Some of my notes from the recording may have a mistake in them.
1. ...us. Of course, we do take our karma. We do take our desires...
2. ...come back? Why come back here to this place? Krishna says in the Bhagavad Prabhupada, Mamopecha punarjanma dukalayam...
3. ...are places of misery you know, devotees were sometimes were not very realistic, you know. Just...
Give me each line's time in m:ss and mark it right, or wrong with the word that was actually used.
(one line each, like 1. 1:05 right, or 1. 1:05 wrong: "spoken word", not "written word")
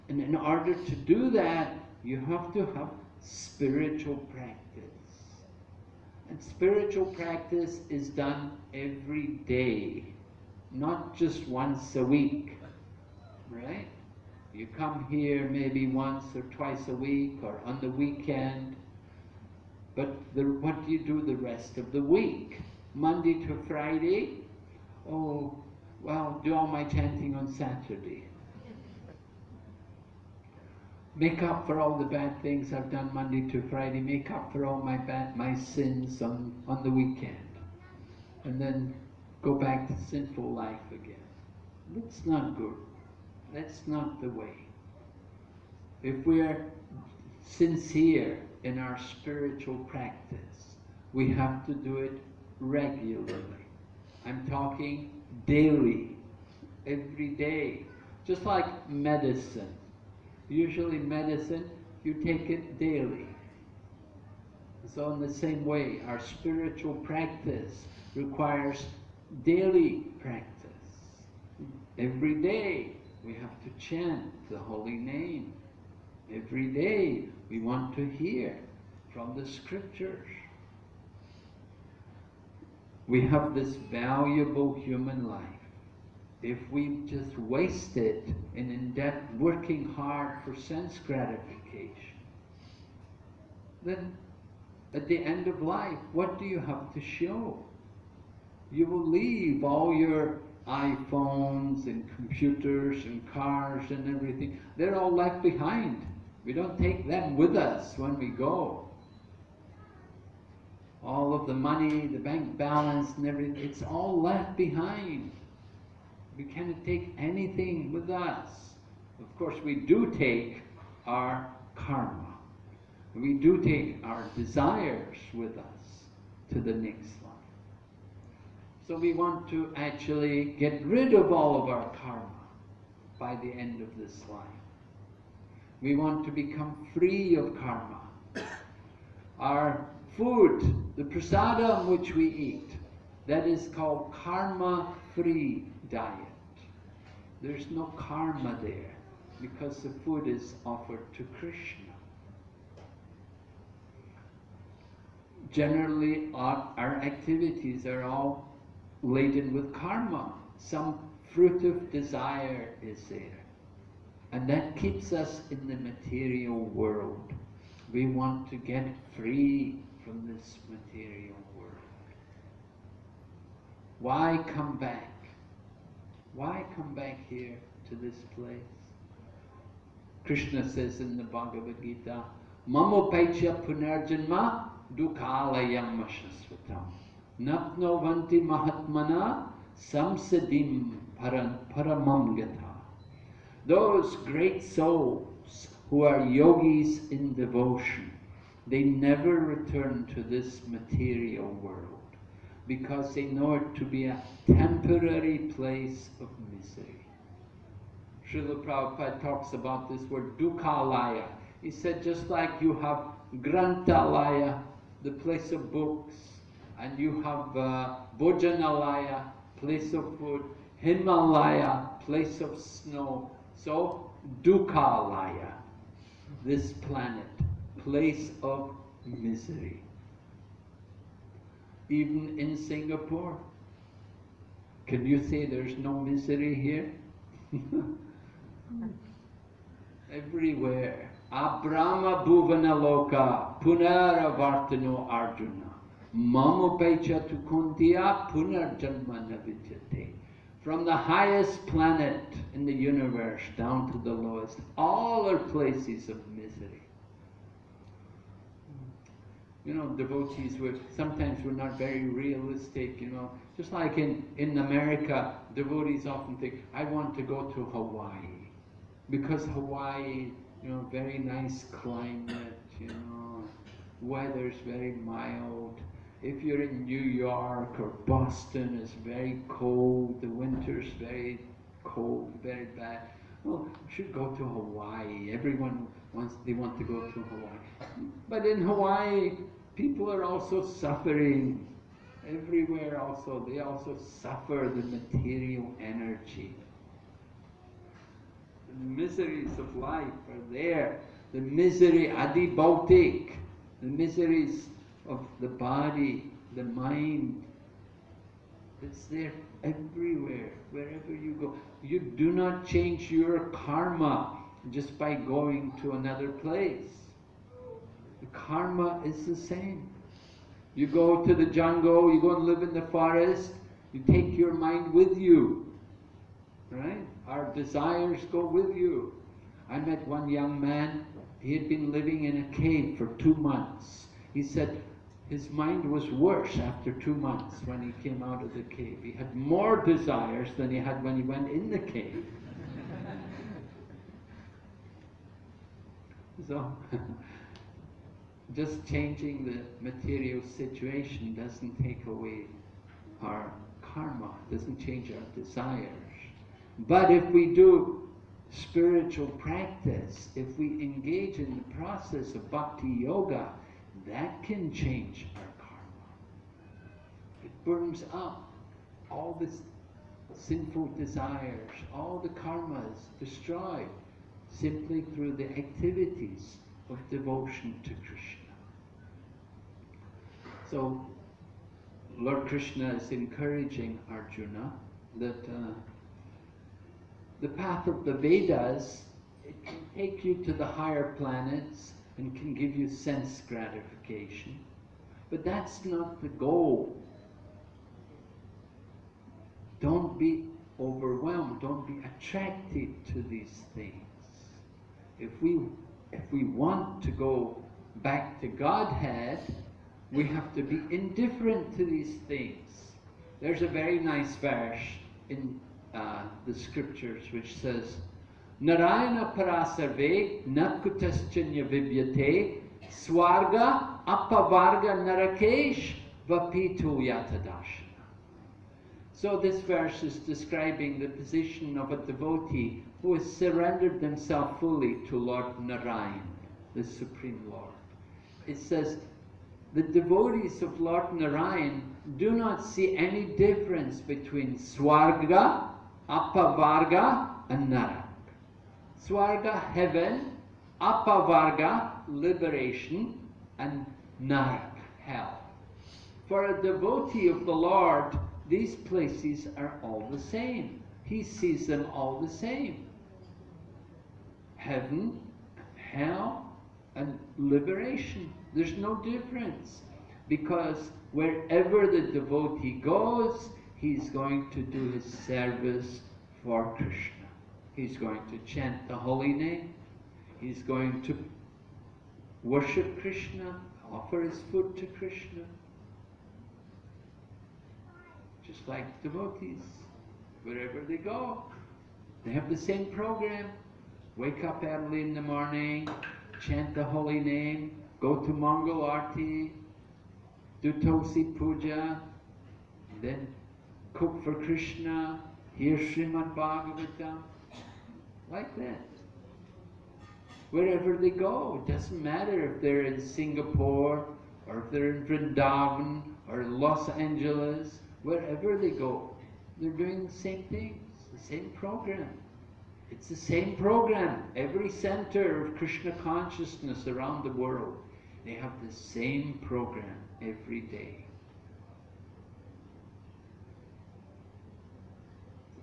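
1. 1:58 right
2. 2:54 wrong: "Gita", not "Prabhupada"
3. 4:15 right.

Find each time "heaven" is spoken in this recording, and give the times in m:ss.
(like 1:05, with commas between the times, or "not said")
7:29, 7:44.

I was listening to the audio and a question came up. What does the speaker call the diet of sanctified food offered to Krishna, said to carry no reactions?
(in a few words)
karma-free diet.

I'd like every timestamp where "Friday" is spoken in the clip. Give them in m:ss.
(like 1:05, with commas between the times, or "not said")
0:23, 0:33.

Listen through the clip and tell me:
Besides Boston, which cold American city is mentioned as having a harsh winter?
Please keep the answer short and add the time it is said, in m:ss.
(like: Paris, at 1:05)
New York, at 4:36.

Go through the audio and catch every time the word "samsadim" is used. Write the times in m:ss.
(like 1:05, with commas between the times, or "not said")
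3:09.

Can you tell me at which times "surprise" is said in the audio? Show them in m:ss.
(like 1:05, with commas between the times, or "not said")
not said.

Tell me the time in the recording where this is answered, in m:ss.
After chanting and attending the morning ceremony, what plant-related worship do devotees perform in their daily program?
8:20.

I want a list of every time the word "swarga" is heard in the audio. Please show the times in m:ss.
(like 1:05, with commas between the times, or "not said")
7:02, 7:24, 7:29.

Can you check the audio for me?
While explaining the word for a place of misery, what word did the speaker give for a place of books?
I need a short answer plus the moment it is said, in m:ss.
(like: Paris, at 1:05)
grantalaya, at 3:33.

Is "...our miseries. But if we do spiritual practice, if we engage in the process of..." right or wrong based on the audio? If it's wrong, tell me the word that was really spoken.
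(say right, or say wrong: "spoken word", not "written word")
wrong: "desires", not "miseries".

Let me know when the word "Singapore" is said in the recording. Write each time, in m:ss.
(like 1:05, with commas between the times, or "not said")
3:52, 8:33.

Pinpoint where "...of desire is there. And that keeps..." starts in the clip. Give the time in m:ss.
2:41.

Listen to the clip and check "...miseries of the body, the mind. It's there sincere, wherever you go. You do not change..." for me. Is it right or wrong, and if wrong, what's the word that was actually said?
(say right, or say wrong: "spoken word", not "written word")
wrong: "everywhere", not "sincere".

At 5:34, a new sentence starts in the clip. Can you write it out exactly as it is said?
He said his mind was worse after two months when he came out of the cave.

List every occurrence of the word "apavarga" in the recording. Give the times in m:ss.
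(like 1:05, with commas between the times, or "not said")
7:04, 7:26, 7:30.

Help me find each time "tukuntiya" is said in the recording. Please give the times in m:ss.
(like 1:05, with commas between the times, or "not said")
4:07.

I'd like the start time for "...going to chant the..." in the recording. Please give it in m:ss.
7:57.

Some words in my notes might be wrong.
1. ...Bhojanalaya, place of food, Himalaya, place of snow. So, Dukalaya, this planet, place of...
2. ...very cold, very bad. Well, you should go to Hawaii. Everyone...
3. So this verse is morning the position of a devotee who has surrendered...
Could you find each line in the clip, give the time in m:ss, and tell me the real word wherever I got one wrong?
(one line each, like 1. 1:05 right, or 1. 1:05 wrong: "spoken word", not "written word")
1. 3:38 right
2. 4:40 right
3. 7:09 wrong: "describing", not "morning".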